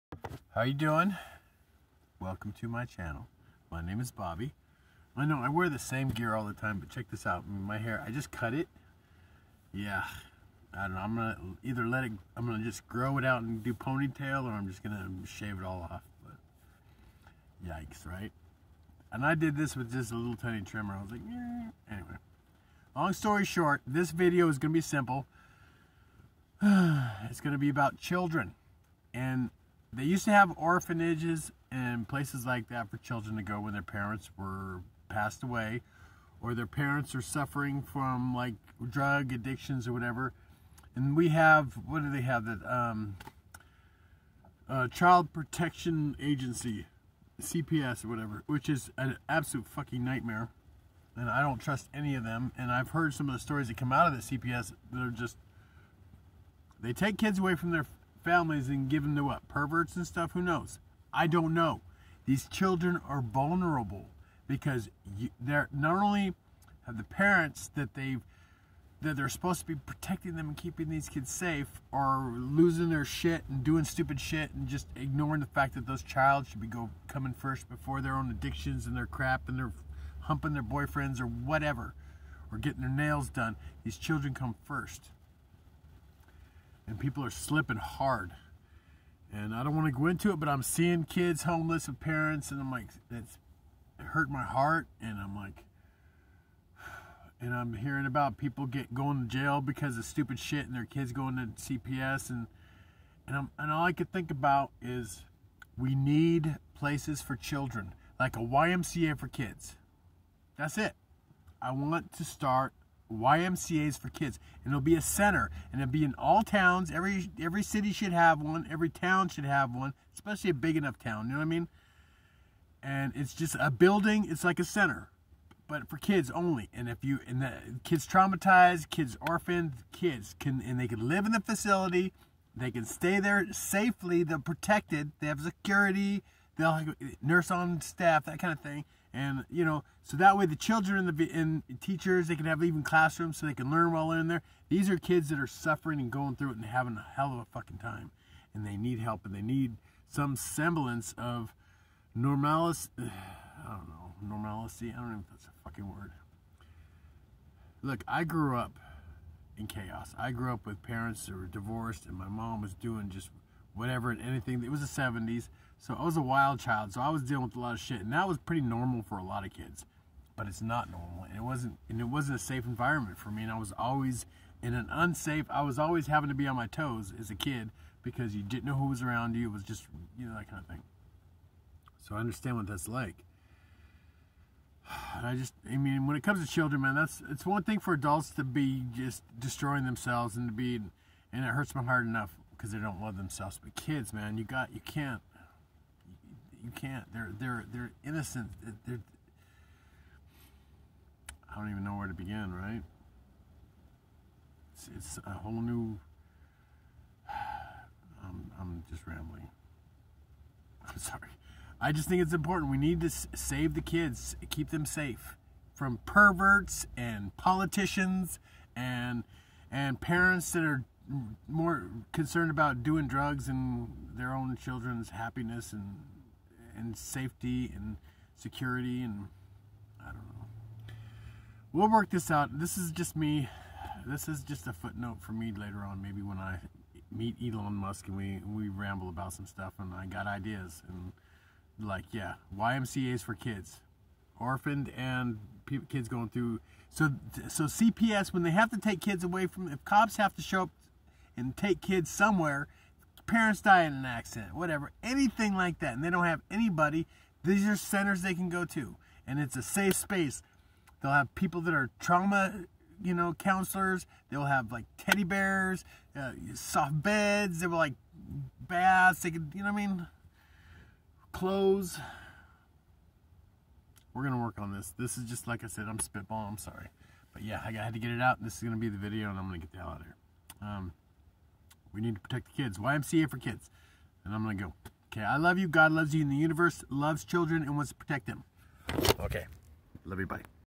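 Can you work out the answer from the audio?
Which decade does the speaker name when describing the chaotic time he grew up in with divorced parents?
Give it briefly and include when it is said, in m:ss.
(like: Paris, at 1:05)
The 70s, at 2:44.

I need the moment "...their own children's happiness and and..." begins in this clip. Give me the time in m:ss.
3:44.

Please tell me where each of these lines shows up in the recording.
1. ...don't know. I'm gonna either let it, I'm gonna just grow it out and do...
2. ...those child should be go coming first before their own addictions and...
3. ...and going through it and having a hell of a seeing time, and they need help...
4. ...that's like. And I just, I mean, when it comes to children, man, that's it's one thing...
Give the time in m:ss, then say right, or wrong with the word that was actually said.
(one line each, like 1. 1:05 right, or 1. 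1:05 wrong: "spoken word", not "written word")
1. 0:10 right
2. 1:15 right
3. 2:25 wrong: "fucking", not "seeing"
4. 3:02 right.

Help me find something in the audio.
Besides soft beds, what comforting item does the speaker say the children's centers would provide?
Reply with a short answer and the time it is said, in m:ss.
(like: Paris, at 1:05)
Teddy bears, at 4:24.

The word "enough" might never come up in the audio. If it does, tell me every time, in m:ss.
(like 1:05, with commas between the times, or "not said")
2:00, 3:12.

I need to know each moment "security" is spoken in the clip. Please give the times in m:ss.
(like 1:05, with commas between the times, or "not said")
2:15, 3:48.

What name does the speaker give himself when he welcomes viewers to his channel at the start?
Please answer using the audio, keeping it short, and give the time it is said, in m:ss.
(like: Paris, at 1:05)
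Bobby, at 0:04.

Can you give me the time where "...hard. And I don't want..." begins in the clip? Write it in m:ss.
1:27.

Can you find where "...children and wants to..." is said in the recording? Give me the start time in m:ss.
4:47.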